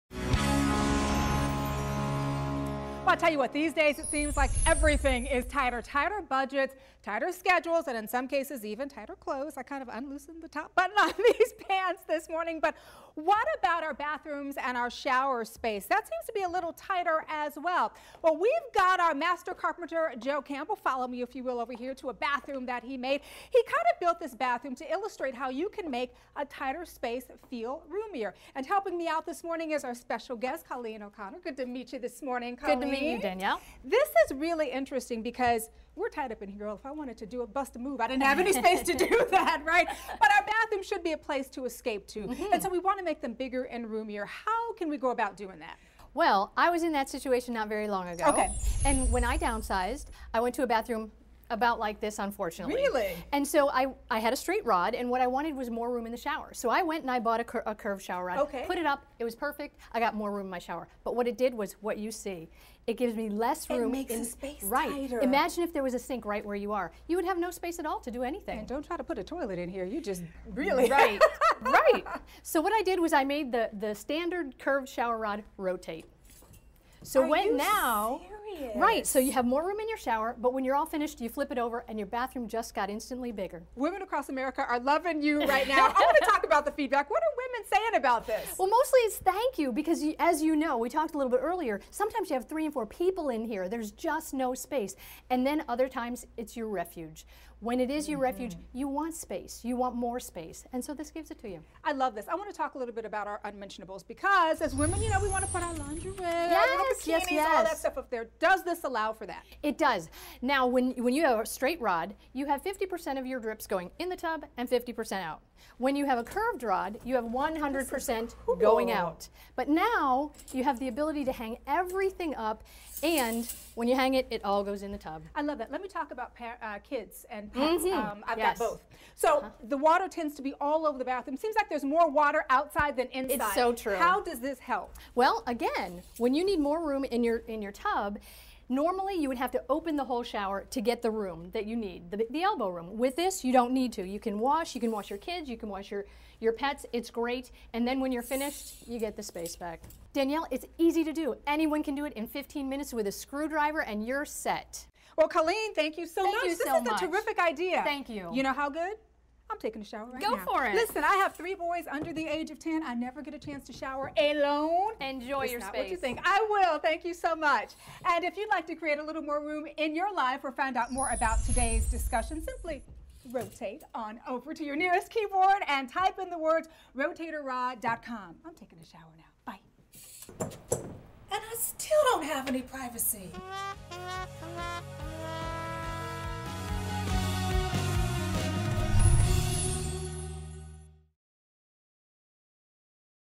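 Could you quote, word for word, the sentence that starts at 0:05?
Tighter budgets, tighter schedules, and in some cases even tighter clothes.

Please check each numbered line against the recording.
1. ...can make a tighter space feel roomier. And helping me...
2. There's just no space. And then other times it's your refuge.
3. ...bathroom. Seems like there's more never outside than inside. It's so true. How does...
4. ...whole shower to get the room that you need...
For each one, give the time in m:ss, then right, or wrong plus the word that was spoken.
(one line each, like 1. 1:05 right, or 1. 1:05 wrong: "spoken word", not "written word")
1. 0:25 right
2. 1:33 right
3. 2:11 wrong: "water", not "never"
4. 2:20 right.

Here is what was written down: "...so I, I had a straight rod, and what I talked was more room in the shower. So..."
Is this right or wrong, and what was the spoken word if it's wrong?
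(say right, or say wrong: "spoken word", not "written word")
wrong: "wanted", not "talked".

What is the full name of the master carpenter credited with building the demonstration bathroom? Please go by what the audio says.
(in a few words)
Joe Campbell.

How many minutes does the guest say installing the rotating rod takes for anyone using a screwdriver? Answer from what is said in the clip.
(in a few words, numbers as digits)
15.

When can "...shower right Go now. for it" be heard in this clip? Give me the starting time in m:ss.
2:39.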